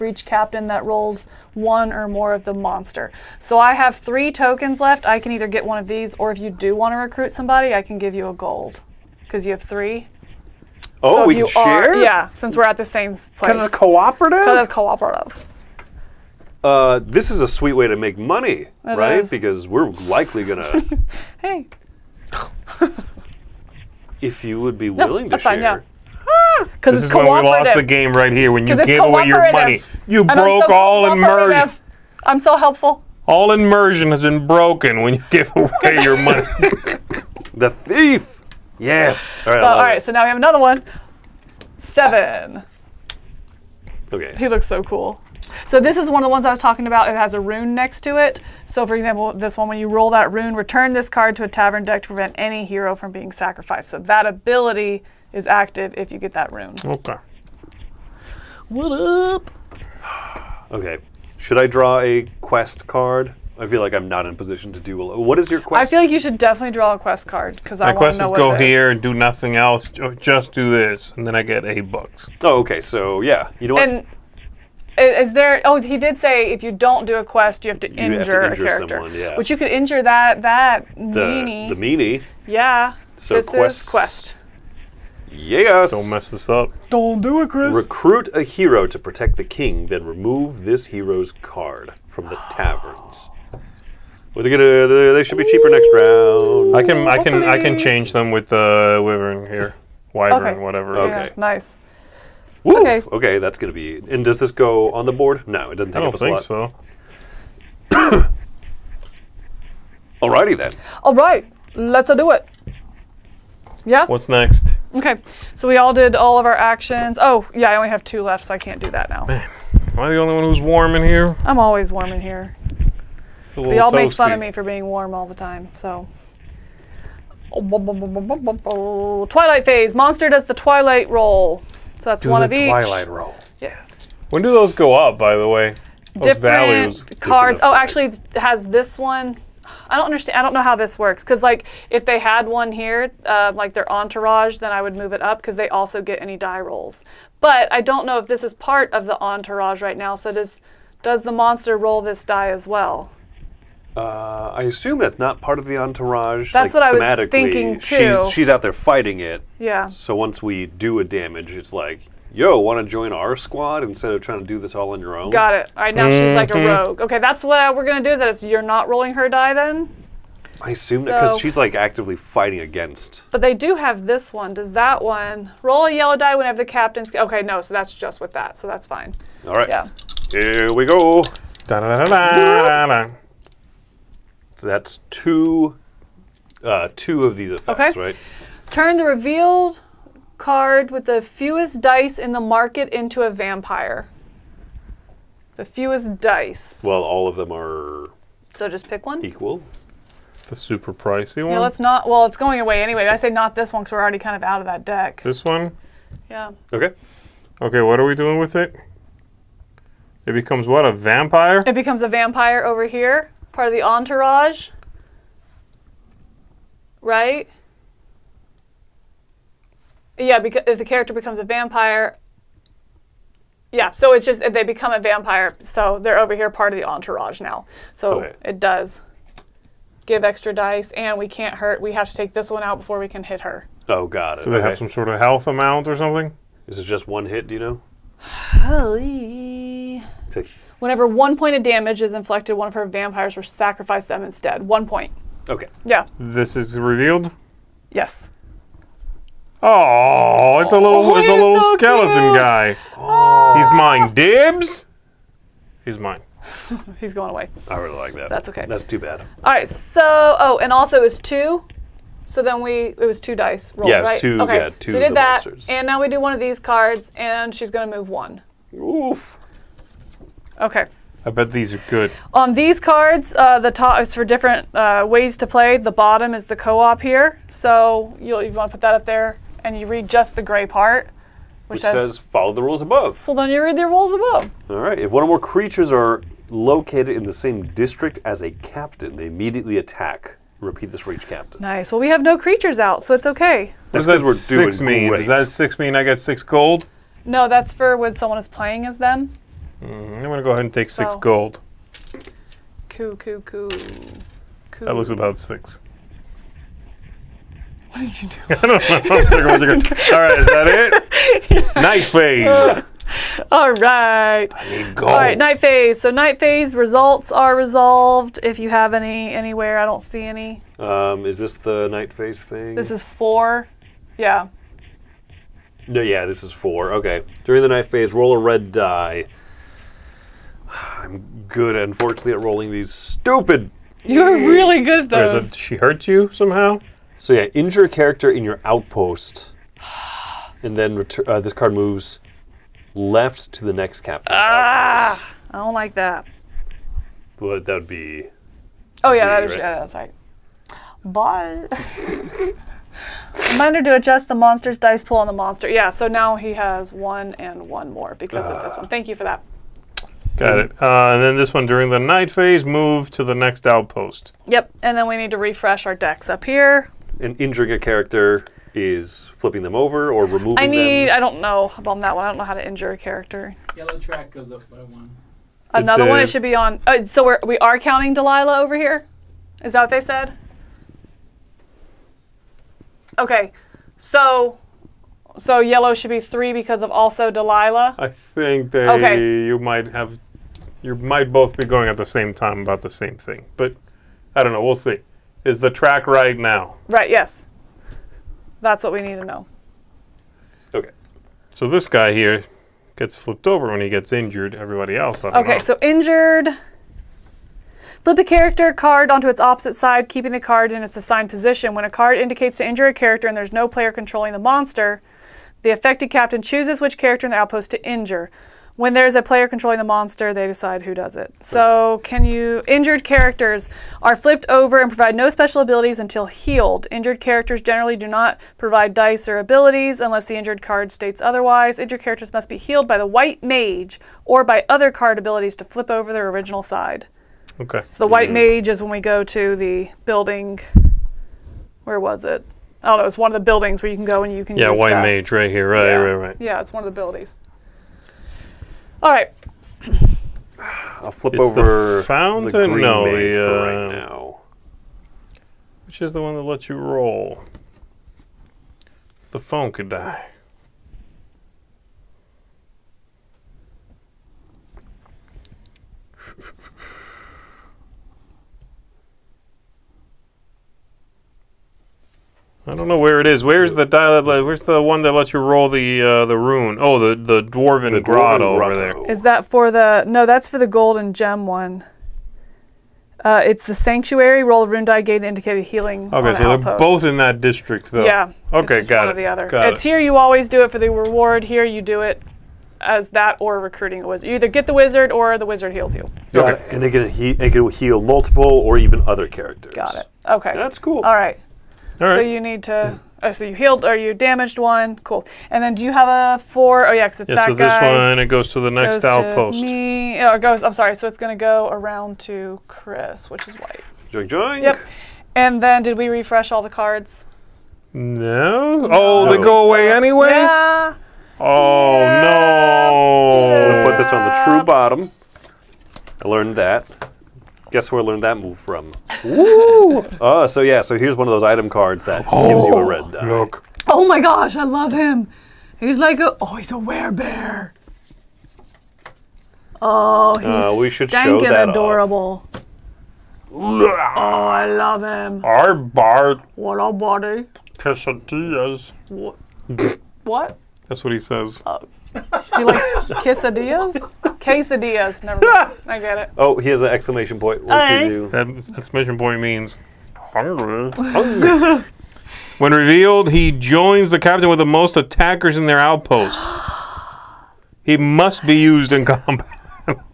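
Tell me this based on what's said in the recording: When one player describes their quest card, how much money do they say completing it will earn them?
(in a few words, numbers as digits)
8.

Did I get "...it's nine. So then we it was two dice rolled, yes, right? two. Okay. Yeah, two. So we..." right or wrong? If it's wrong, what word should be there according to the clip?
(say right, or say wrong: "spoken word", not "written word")
wrong: "two", not "nine".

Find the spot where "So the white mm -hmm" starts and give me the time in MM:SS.
07:17.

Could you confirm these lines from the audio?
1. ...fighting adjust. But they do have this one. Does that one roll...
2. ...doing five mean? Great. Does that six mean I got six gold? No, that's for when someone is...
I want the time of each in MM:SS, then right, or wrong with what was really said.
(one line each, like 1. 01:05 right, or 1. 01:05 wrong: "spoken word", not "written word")
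1. 02:52 wrong: "against", not "adjust"
2. 04:54 wrong: "six", not "five".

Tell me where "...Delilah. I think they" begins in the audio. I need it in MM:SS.
06:27.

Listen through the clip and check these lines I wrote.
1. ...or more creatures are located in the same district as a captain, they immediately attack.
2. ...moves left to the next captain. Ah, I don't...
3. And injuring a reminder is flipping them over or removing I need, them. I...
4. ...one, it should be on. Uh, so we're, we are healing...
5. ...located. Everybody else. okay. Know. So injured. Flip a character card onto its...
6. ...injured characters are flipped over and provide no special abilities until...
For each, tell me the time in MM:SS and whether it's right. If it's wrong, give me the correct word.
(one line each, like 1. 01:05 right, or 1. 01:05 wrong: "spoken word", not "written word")
1. 04:45 right
2. 05:41 right
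3. 06:07 wrong: "character", not "reminder"
4. 06:16 wrong: "counting", not "healing"
5. 06:44 wrong: "injured", not "located"
6. 07:02 right.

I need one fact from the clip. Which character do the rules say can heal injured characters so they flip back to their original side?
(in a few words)
white mage.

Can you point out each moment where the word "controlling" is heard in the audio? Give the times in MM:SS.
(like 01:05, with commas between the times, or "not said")
06:53, 06:59.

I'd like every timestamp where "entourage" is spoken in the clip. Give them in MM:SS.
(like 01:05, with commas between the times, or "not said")
02:23, 02:29, 02:35, 03:33, 03:46.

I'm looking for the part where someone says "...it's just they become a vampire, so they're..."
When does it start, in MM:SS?
03:44.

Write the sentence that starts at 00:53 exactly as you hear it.
So that ability is active if you get that rune.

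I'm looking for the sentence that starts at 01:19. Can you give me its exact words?
which you could injure that that the, meanie.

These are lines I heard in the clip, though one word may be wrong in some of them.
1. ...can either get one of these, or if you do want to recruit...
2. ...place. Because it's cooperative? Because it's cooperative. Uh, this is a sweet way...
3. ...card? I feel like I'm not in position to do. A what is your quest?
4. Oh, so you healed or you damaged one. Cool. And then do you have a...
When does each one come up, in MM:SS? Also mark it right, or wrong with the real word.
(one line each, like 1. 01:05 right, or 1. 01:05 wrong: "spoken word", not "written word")
1. 00:05 right
2. 00:13 right
3. 01:02 right
4. 08:23 right.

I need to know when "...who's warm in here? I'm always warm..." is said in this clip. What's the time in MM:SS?
02:00.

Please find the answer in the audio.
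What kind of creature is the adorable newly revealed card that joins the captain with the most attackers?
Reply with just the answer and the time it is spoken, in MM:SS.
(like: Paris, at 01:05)
werebear, at 08:56.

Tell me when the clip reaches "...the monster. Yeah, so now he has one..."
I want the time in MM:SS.
05:55.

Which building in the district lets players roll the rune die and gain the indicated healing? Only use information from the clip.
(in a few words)
sanctuary.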